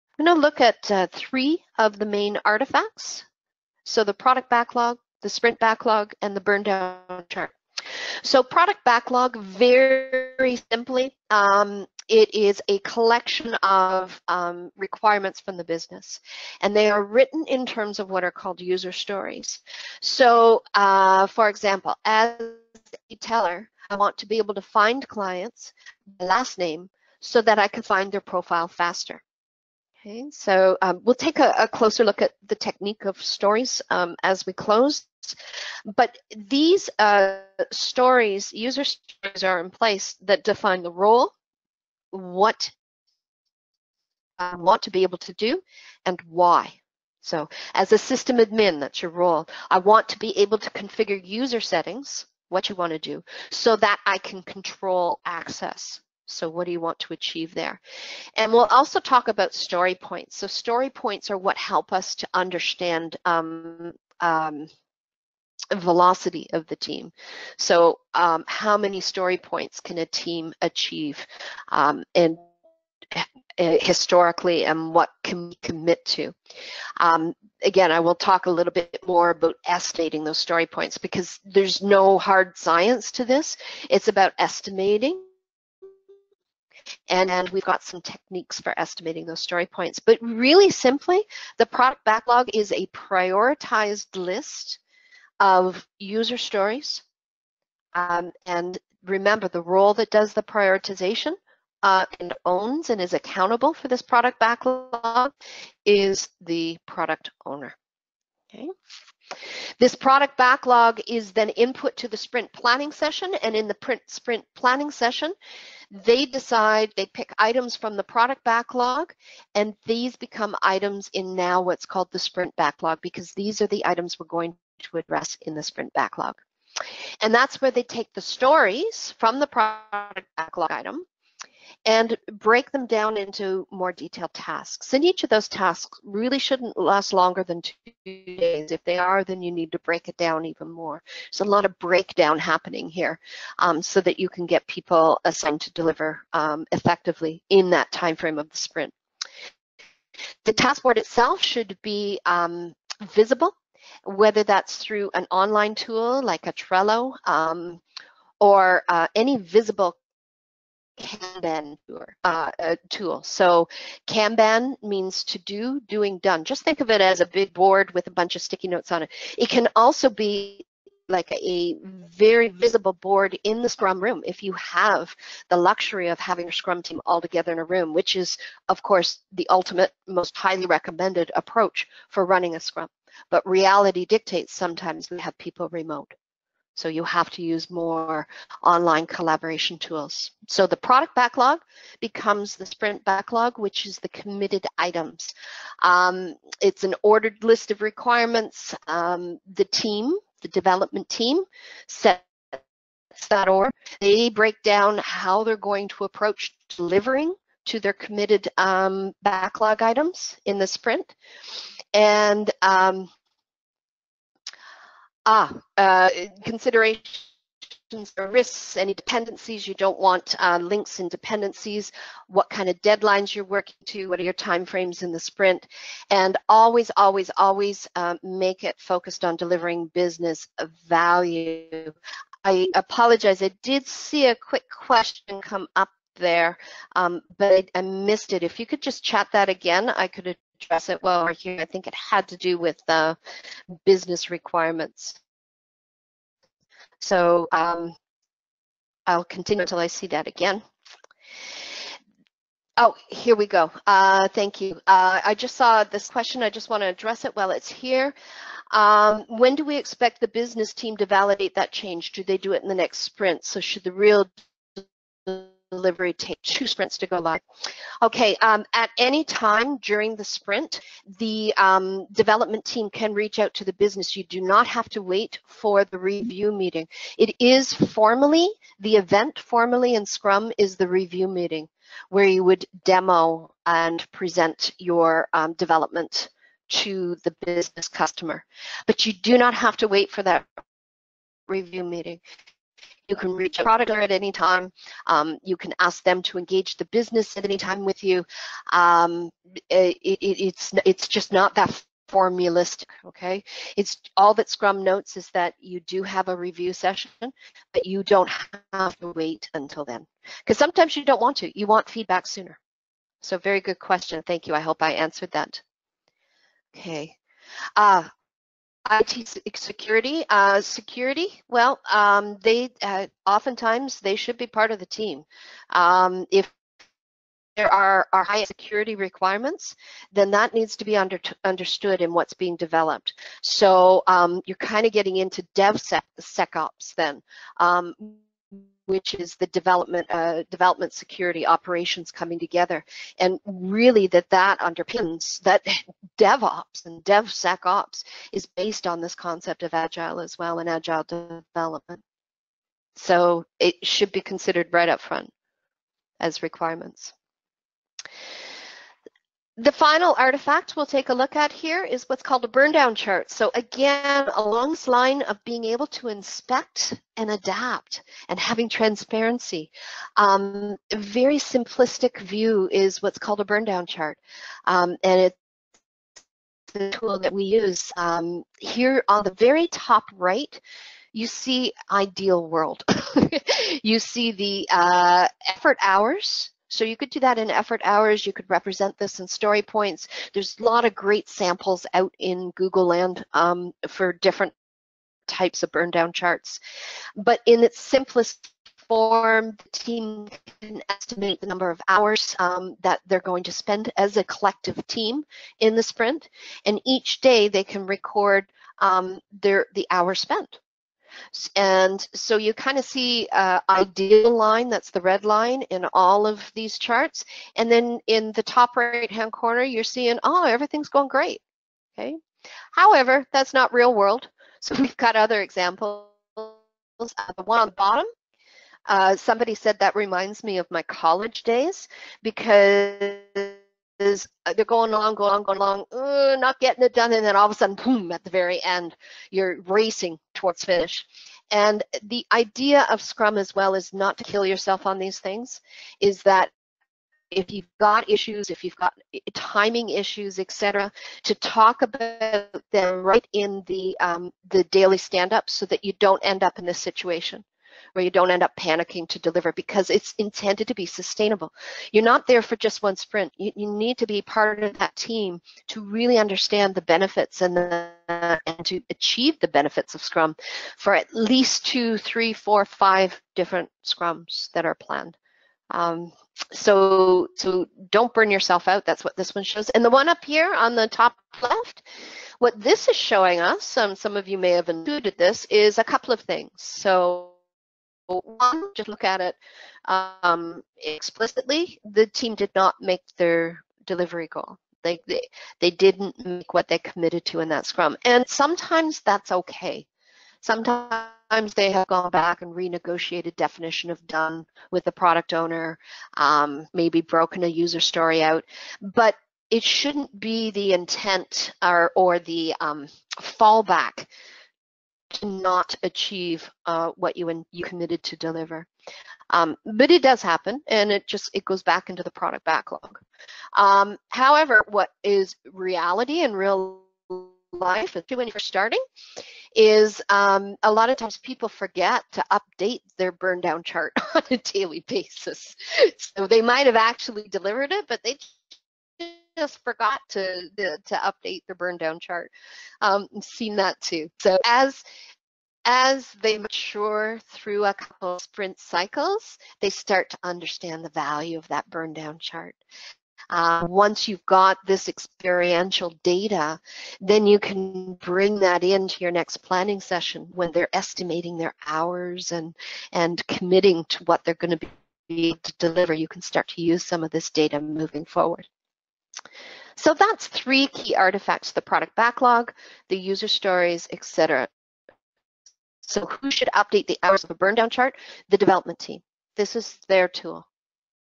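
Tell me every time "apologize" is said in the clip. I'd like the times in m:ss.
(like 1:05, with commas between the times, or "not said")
3:52.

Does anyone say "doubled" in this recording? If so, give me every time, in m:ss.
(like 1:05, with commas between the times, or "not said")
not said.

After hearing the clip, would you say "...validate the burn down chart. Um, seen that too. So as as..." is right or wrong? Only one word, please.
wrong.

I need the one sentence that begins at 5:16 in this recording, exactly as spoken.
Okay, uh, IT security, uh, security.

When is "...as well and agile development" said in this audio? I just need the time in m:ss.
5:50.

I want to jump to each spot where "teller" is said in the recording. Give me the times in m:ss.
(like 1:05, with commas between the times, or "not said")
0:23.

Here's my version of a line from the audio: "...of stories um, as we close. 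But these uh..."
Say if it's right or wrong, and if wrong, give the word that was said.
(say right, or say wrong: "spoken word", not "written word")
right.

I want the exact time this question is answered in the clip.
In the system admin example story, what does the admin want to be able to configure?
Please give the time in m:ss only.
0:51.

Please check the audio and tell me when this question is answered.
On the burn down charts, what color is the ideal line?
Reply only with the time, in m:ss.
6:55.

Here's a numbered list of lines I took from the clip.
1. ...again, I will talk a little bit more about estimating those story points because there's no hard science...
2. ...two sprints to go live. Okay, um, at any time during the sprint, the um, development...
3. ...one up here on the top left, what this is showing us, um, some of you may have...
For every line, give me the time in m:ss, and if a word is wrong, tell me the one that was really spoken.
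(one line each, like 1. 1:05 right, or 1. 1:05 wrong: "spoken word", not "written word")
1. 1:17 right
2. 4:26 right
3. 7:59 right.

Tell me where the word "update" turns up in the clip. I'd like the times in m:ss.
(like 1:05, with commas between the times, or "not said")
8:52, 9:00, 9:36.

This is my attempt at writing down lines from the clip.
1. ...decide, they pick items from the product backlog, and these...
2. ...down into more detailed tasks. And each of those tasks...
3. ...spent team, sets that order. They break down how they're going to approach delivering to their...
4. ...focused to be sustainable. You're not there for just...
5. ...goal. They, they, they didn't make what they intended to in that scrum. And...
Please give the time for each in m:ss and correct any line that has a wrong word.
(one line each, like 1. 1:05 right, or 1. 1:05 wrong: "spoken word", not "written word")
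1. 1:56 right
2. 2:12 right
3. 3:20 wrong: "development", not "spent"
4. 7:40 wrong: "intended", not "focused"
5. 8:14 wrong: "committed", not "intended".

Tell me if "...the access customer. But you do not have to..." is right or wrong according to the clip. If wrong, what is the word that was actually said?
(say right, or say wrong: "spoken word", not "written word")
wrong: "business", not "access".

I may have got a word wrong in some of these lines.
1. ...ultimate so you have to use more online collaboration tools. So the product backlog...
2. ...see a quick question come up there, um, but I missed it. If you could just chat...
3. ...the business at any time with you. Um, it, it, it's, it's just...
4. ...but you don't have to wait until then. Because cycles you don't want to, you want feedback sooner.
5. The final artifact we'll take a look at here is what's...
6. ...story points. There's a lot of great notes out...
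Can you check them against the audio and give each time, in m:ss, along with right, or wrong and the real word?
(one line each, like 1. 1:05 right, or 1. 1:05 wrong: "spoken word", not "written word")
1. 3:05 wrong: "remote", not "ultimate"
2. 3:53 right
3. 4:56 right
4. 5:07 wrong: "sometimes", not "cycles"
5. 5:59 right
6. 6:29 wrong: "samples", not "notes".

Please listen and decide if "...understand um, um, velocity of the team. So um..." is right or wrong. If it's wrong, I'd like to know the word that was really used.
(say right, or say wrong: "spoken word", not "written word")
right.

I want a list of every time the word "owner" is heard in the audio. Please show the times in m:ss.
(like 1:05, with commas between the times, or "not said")
1:47, 8:25.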